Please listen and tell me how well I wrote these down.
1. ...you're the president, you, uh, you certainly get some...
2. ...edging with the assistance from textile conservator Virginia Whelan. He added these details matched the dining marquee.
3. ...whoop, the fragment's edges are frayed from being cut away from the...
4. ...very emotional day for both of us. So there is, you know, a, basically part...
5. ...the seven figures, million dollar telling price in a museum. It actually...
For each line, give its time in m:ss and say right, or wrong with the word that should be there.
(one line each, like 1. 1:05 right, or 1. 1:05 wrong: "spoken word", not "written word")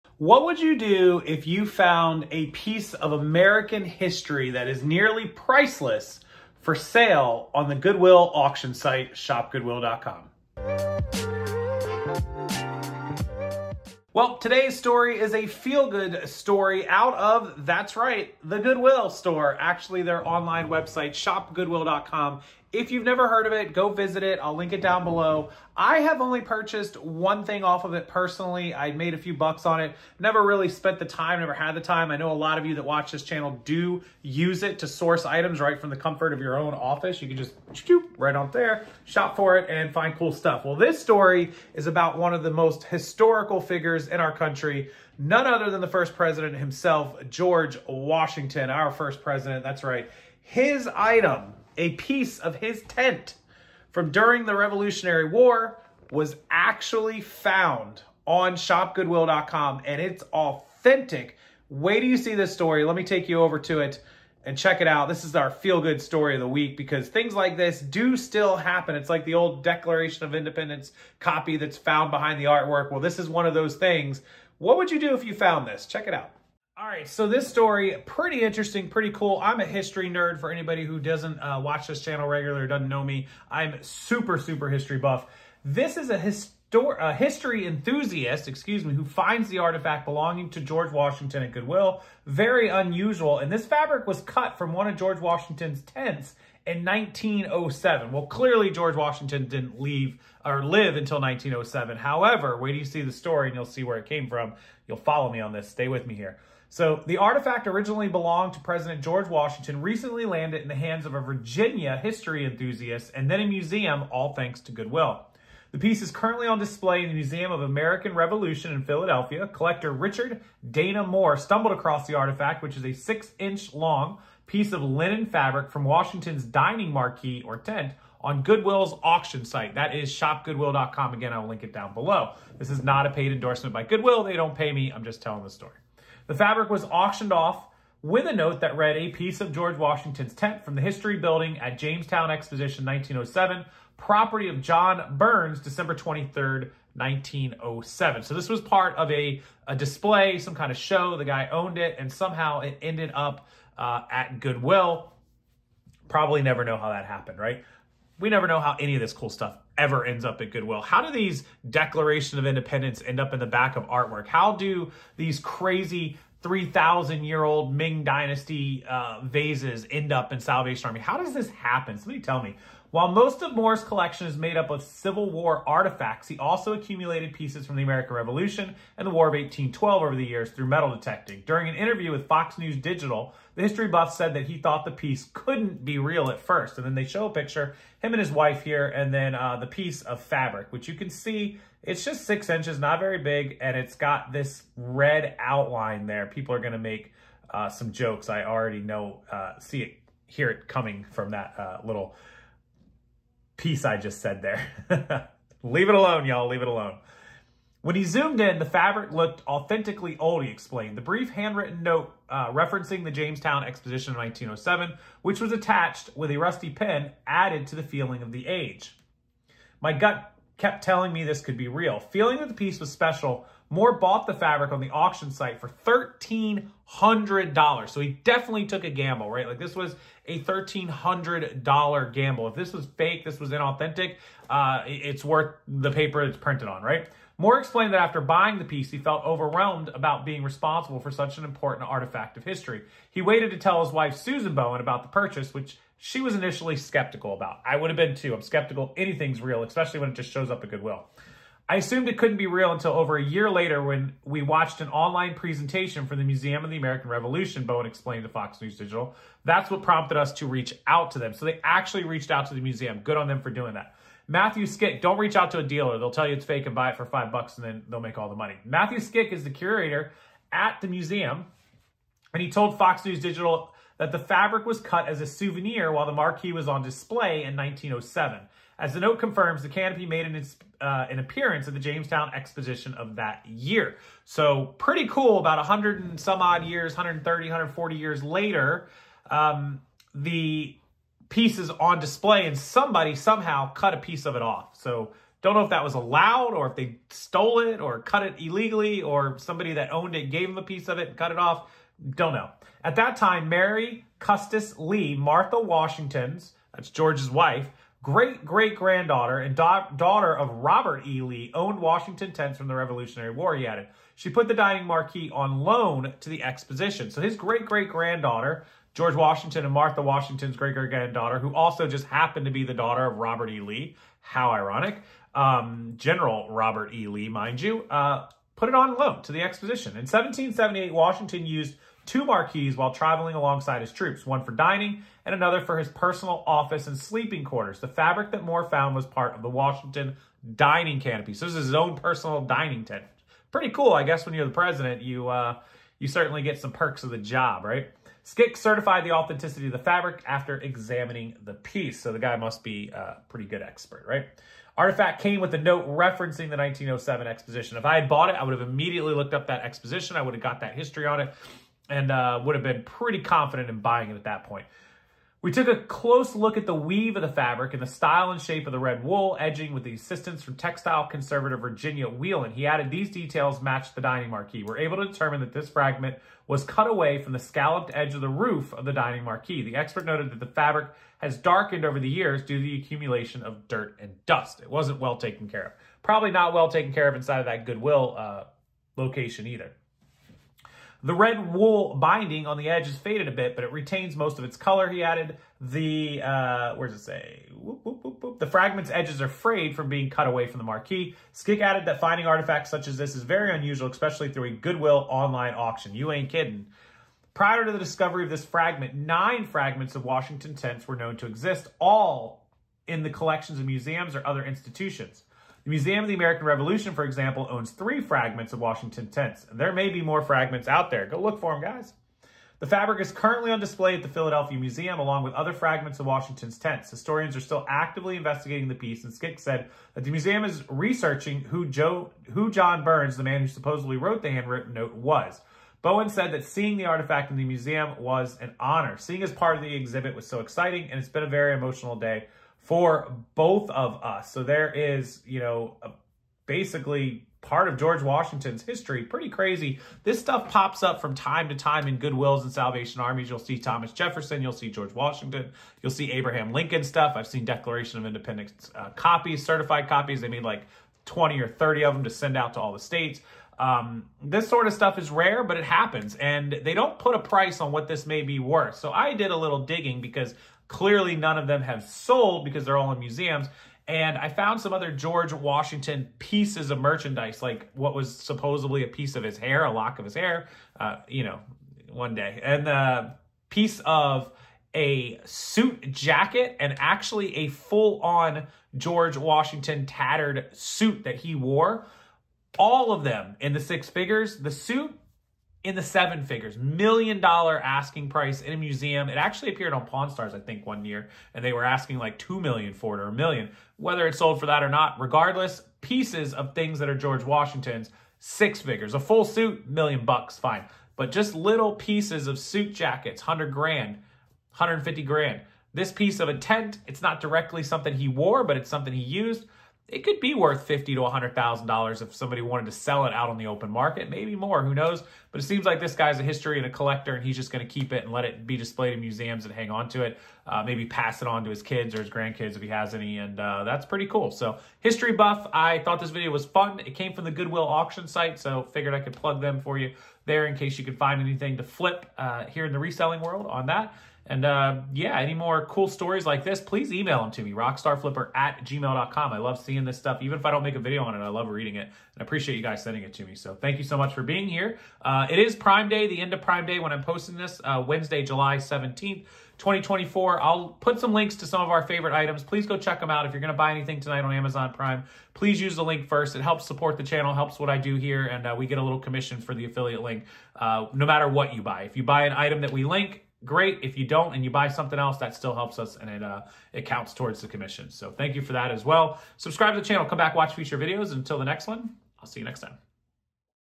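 1. 5:44 right
2. 6:09 right
3. 6:38 right
4. 7:21 right
5. 8:15 wrong: "asking", not "telling".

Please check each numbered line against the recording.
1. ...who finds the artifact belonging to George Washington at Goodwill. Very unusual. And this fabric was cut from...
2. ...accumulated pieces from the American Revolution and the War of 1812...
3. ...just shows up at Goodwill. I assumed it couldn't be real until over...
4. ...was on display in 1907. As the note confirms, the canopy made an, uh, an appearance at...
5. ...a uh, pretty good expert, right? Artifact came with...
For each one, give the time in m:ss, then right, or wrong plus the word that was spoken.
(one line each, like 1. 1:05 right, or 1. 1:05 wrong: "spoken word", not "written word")
1. 1:28 right
2. 2:56 right
3. 4:10 right
4. 4:36 right
5. 5:52 right.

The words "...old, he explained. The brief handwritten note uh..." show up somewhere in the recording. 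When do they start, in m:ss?
3:30.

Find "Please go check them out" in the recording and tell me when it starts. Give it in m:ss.
9:22.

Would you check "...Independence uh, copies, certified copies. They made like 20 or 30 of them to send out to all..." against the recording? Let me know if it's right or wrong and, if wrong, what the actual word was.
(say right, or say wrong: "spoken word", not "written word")
right.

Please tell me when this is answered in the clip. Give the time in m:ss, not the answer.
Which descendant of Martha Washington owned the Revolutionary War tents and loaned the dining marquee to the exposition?
5:03.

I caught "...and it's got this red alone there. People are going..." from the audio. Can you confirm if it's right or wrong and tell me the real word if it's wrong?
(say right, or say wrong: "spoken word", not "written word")
wrong: "outline", not "alone".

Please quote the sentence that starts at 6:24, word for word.
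It wasn't well taken care of.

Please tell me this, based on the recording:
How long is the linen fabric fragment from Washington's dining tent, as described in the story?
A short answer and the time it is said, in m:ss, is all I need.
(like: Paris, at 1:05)
6 inches, at 2:02.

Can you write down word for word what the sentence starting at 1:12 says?
Well, this is one of those things.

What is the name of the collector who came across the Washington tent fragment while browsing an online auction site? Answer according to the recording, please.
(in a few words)
Richard Dana Moore.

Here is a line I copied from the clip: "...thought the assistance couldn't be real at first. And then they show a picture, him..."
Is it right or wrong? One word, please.
wrong.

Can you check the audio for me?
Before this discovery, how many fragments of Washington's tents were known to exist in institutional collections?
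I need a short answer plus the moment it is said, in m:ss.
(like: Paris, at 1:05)
9, at 6:48.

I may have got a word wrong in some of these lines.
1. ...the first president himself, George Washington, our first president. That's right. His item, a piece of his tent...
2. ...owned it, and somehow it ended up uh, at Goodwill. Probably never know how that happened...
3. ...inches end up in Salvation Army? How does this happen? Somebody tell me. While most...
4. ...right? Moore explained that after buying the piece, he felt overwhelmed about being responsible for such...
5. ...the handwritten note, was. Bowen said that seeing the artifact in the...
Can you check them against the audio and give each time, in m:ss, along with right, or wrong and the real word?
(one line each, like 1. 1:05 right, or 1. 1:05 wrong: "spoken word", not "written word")
1. 0:45 right
2. 2:31 right
3. 2:49 wrong: "vases", not "inches"
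4. 3:56 right
5. 7:14 right.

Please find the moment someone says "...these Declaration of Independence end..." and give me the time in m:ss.
2:41.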